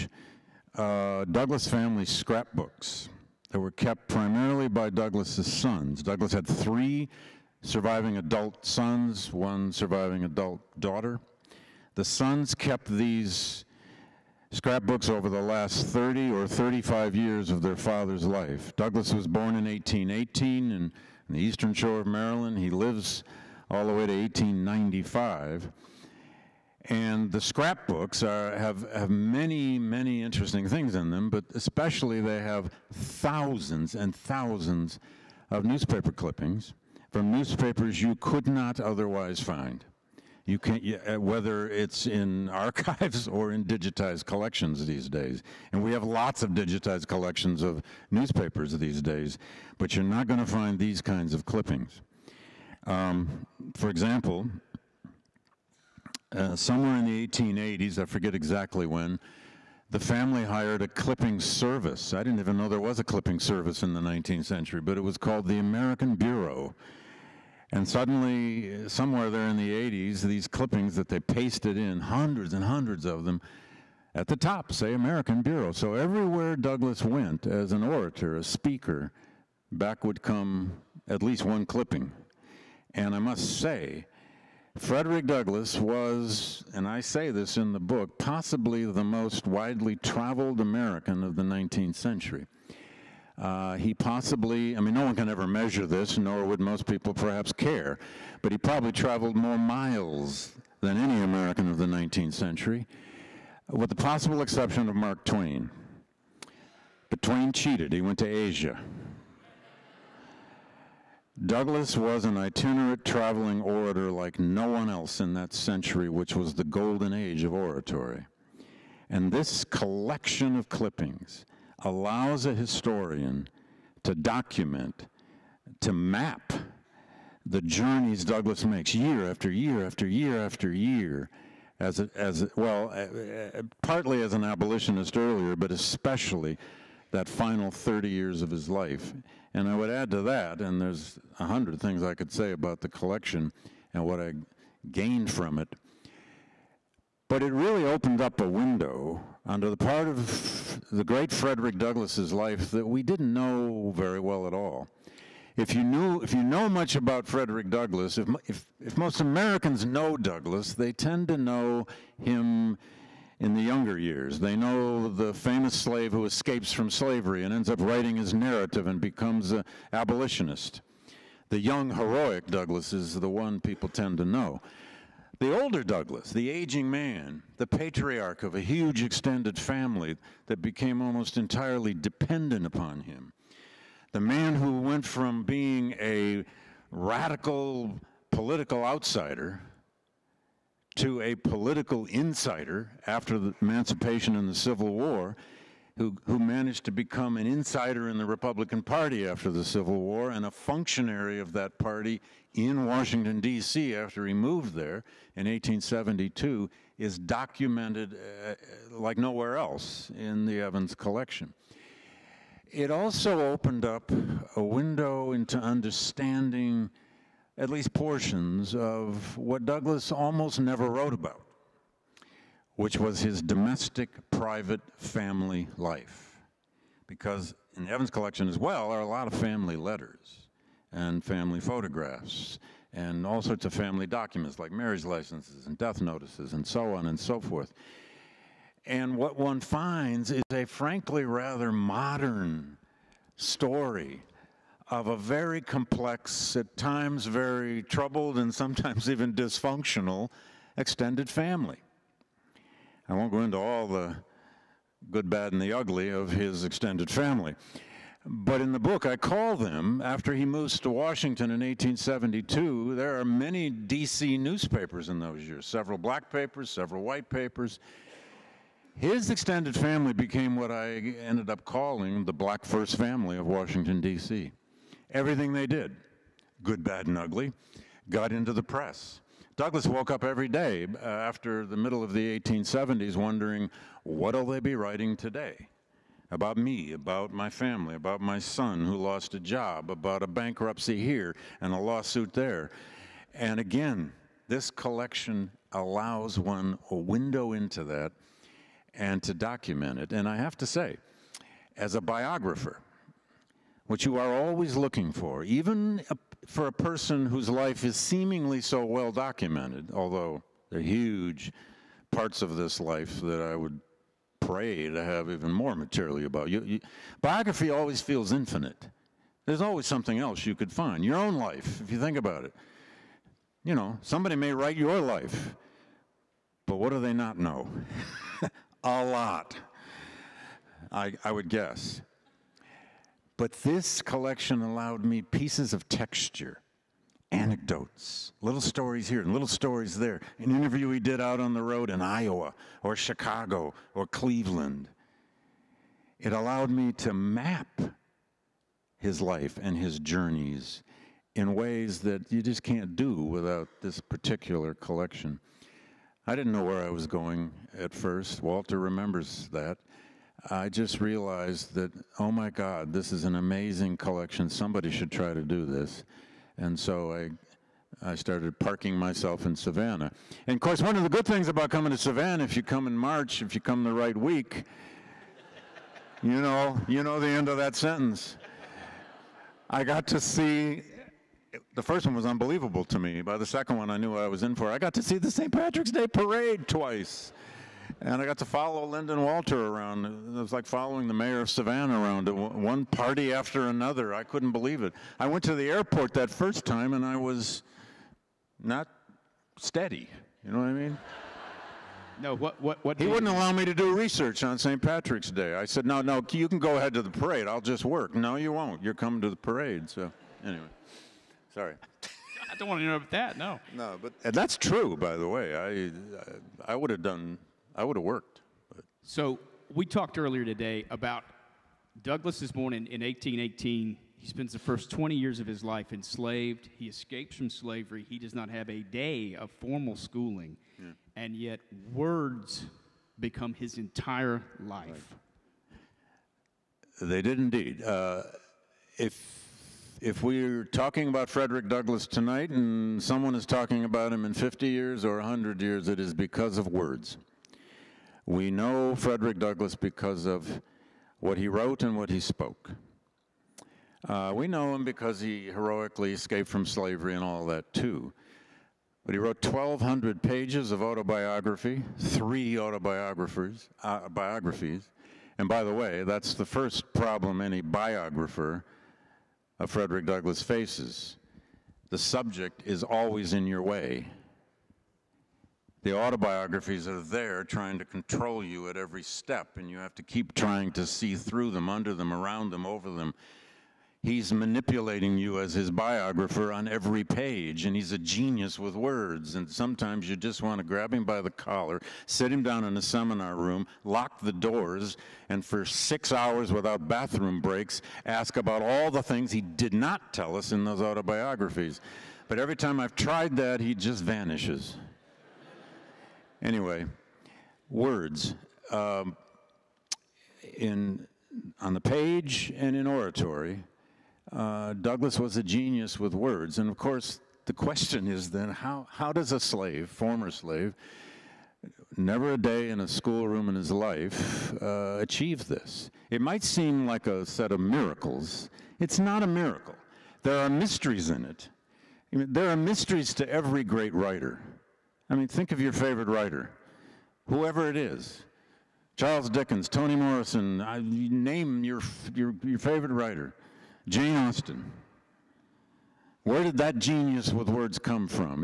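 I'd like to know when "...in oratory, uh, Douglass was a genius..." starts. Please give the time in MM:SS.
08:32.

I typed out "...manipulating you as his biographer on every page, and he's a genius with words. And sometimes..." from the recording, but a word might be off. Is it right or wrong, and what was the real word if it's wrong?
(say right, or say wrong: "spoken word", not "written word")
right.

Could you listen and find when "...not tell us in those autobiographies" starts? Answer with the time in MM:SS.
08:19.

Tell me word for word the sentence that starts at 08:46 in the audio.
It might seem like a set of miracles.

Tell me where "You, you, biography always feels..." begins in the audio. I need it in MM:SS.
05:16.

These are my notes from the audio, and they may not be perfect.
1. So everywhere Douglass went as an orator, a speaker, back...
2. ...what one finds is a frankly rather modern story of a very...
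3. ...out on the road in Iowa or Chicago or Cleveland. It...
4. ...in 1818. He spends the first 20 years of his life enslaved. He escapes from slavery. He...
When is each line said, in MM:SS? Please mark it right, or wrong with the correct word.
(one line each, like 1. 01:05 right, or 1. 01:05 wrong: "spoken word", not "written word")
1. 01:15 right
2. 03:59 right
3. 05:41 right
4. 07:02 right.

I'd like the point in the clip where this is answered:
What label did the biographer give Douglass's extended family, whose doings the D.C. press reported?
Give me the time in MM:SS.
04:32.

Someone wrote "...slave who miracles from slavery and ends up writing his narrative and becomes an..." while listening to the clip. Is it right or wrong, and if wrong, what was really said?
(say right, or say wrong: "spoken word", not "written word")
wrong: "escapes", not "miracles".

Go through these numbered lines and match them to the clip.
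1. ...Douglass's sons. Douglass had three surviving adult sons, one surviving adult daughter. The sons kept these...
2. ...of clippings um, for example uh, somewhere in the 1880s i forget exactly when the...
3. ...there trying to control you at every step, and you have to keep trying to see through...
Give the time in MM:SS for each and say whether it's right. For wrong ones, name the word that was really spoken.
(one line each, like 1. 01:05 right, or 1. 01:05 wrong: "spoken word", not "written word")
1. 00:04 right
2. 00:51 right
3. 07:57 right.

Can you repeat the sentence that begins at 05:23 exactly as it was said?
You know, somebody may write your life, but what do they not know?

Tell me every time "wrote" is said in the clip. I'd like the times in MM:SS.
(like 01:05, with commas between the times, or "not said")
03:40, 07:31, 07:39.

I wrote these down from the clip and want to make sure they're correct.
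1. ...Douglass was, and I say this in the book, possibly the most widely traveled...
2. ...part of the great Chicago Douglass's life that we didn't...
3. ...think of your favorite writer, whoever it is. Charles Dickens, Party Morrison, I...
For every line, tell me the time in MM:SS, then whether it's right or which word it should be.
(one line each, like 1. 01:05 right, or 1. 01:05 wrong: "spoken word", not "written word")
1. 01:25 right
2. 02:29 wrong: "Frederick", not "Chicago"
3. 08:55 wrong: "Toni", not "Party".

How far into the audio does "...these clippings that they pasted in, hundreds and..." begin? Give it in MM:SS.
01:10.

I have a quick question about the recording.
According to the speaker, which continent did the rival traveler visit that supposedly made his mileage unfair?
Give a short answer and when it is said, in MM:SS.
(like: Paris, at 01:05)
Asia, at 01:48.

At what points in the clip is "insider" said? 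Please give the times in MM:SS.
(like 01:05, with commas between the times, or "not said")
03:12, 03:17.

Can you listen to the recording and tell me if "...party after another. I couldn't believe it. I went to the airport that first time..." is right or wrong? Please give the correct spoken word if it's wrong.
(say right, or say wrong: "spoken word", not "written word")
right.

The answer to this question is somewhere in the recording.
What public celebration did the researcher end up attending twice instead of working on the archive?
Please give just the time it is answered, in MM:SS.
06:25.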